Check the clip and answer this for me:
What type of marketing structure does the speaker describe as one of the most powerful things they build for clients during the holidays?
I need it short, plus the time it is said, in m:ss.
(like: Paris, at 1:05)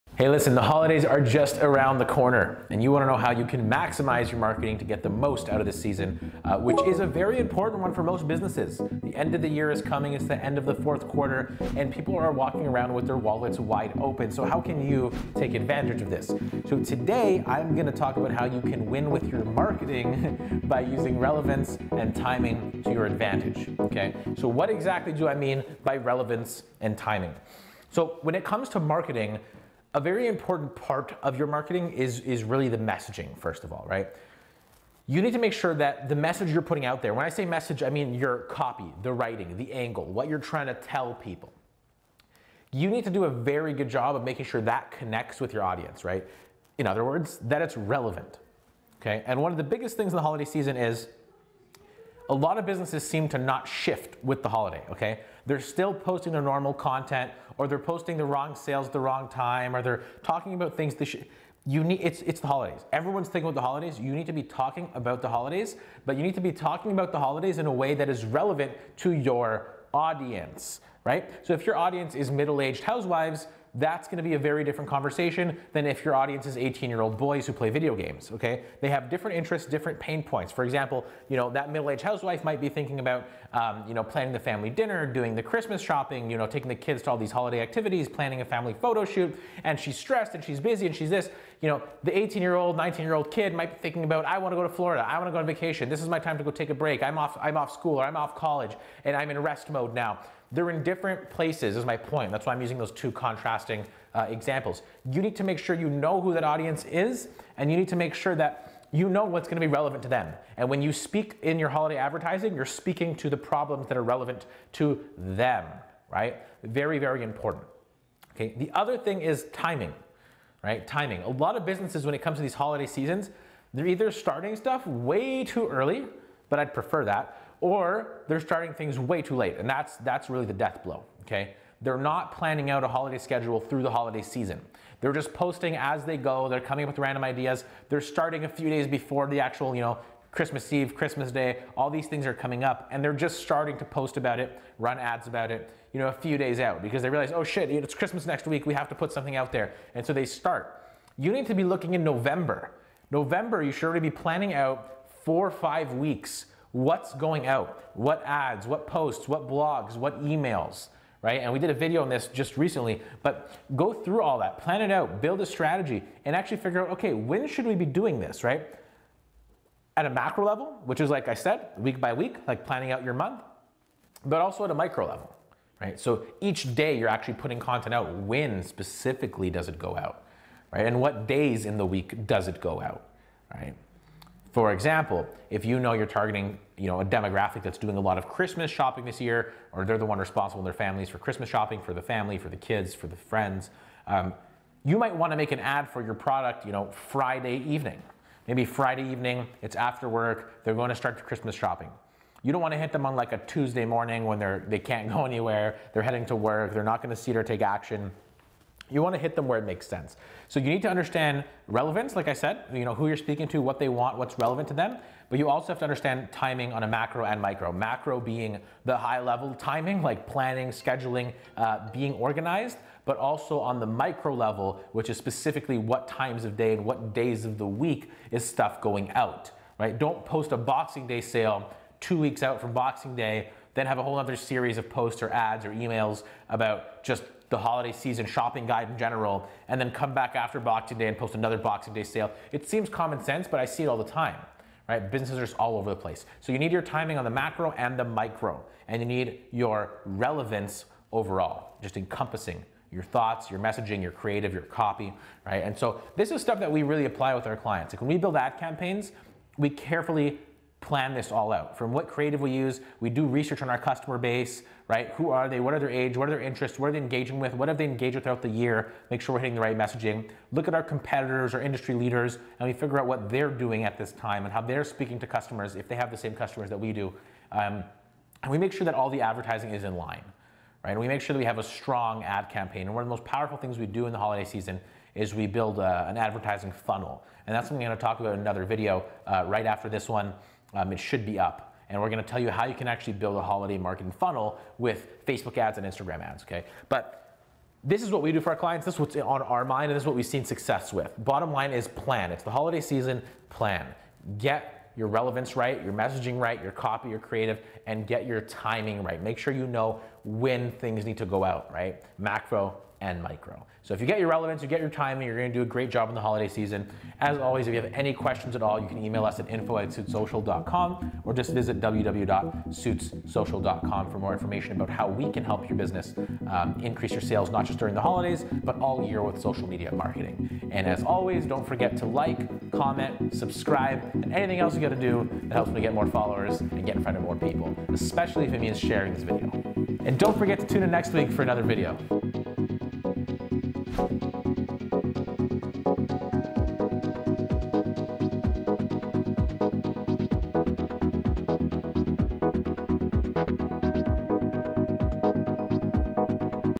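advertising funnel, at 4:46.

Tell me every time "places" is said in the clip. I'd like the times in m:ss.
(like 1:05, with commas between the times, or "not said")
1:41, 4:05.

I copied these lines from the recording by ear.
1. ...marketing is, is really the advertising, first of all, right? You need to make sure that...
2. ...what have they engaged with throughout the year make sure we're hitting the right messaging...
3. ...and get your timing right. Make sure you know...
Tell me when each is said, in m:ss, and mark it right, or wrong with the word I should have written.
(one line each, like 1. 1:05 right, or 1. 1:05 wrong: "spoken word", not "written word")
1. 0:31 wrong: "messaging", not "advertising"
2. 4:27 right
3. 5:07 right.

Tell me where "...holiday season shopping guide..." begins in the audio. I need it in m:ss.
3:57.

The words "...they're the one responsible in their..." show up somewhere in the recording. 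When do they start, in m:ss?
3:09.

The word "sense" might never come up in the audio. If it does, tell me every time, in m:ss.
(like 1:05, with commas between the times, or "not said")
3:29, 4:03.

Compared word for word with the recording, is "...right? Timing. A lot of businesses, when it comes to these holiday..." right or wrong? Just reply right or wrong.
right.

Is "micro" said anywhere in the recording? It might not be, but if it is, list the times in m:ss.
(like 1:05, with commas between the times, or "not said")
2:54, 3:37, 3:43, 4:08, 5:13.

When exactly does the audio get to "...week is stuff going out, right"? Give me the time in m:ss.
3:47.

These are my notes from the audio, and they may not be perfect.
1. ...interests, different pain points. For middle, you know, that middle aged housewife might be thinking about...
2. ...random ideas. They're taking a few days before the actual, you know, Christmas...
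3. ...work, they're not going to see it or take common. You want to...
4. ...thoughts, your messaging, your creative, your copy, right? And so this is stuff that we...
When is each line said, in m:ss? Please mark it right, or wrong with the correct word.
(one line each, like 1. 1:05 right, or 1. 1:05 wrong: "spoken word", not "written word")
1. 1:19 wrong: "example", not "middle"
2. 2:16 wrong: "starting", not "taking"
3. 3:26 wrong: "action", not "common"
4. 4:13 right.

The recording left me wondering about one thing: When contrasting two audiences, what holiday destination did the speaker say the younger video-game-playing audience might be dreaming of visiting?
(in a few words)
Florida.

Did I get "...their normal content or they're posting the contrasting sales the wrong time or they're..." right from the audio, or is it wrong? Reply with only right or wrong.
wrong.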